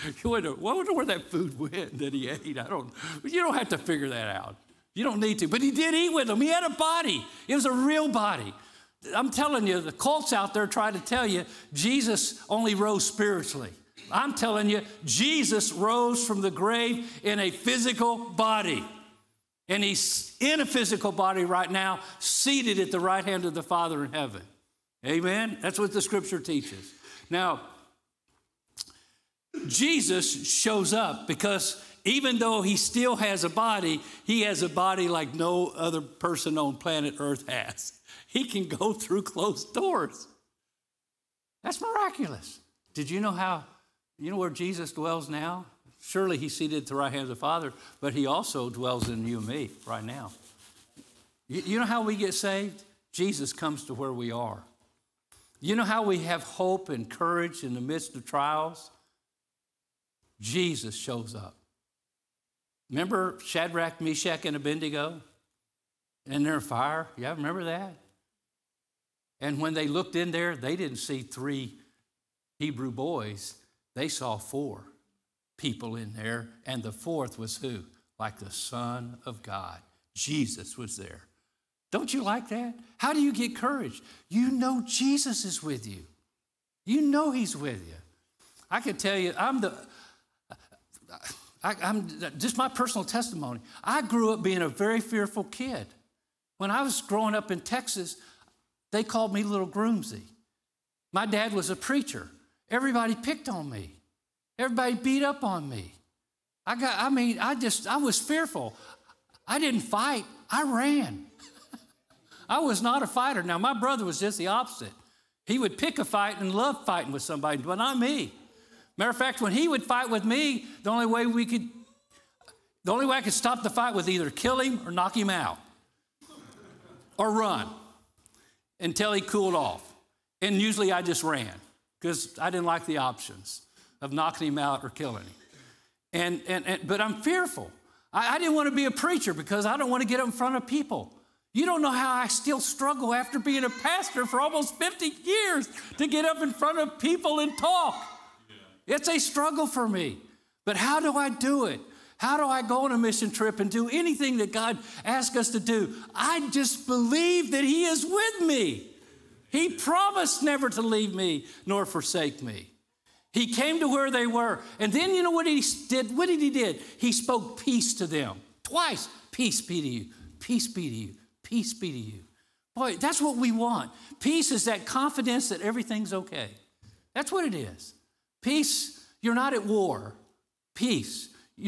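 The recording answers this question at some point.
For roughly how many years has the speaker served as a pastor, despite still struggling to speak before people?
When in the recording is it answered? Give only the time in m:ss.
2:24.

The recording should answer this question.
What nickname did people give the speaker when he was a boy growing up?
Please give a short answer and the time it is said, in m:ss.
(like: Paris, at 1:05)
Little Groomsy, at 1:39.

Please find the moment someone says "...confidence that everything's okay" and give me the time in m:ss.
2:54.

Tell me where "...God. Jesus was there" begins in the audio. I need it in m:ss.
1:19.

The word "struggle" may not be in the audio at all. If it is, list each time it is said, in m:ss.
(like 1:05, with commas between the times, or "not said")
2:22, 2:29.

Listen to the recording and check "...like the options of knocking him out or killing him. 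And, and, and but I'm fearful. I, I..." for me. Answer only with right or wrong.
right.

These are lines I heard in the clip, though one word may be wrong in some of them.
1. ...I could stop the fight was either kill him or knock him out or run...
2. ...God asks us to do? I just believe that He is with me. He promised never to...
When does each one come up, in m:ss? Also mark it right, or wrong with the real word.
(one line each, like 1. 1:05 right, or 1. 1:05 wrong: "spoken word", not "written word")
1. 2:03 right
2. 2:34 right.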